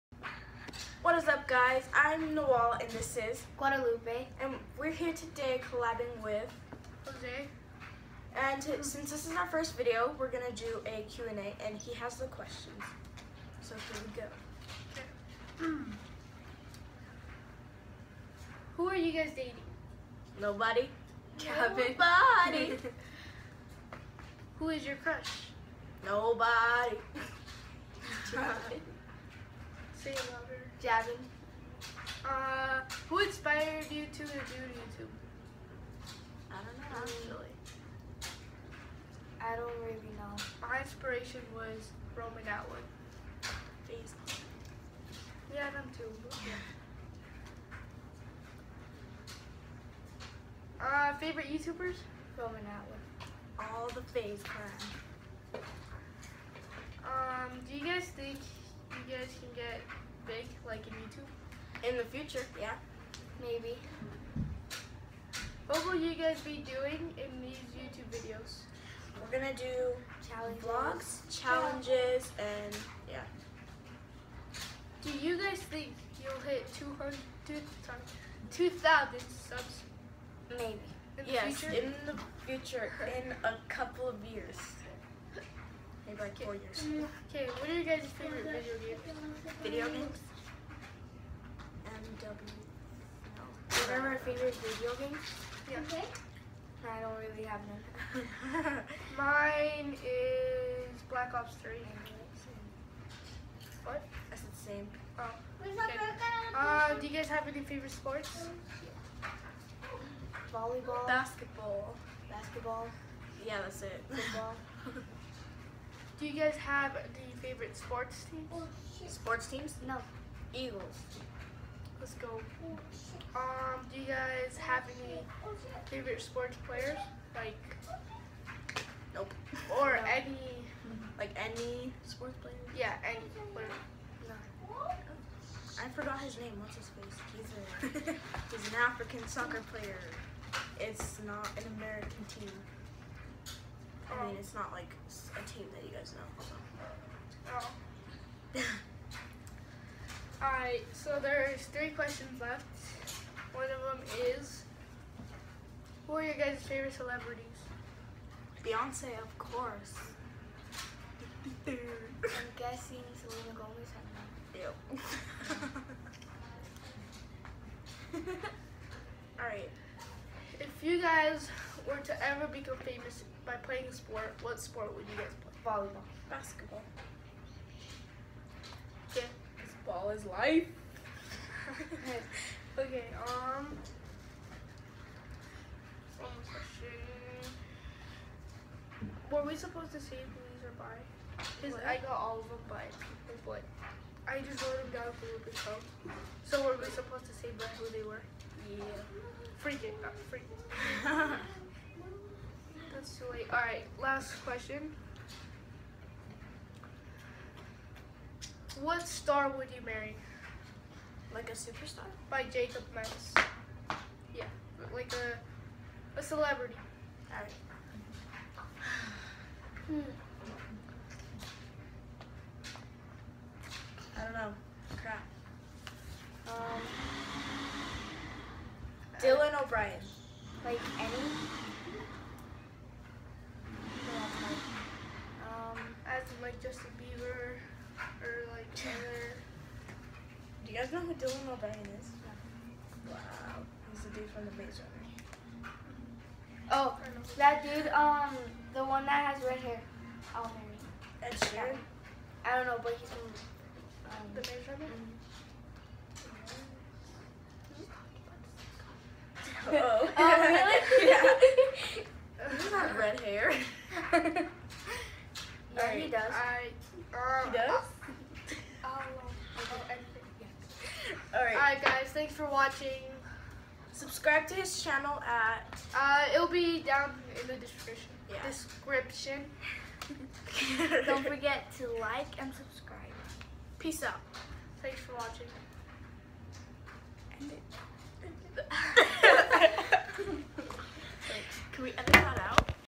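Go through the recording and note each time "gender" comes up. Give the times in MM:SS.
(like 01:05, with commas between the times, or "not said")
not said.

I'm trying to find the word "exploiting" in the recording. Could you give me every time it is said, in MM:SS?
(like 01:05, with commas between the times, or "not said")
not said.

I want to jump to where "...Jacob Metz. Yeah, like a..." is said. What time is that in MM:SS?
03:32.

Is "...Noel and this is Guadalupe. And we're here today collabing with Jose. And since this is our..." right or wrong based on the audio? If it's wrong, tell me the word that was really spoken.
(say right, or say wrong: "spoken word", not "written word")
right.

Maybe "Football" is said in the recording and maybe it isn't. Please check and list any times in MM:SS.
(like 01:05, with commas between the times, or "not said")
01:54.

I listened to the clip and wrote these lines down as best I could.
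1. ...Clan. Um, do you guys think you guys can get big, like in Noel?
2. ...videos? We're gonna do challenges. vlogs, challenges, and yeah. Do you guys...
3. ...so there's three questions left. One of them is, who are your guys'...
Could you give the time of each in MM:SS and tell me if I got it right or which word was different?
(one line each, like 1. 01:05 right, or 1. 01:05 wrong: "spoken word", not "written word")
1. 00:54 wrong: "YouTube", not "Noel"
2. 01:08 right
3. 02:30 right.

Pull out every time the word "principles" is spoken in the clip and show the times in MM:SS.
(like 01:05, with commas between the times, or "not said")
not said.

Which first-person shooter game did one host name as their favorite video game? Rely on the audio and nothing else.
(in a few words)
Black Ops 3.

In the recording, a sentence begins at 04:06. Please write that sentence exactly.
Oh, that dude, um, the one that has red hair.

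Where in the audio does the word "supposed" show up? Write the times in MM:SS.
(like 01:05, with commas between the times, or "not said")
03:09, 03:16.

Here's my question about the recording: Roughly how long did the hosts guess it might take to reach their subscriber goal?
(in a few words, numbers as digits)
4 years.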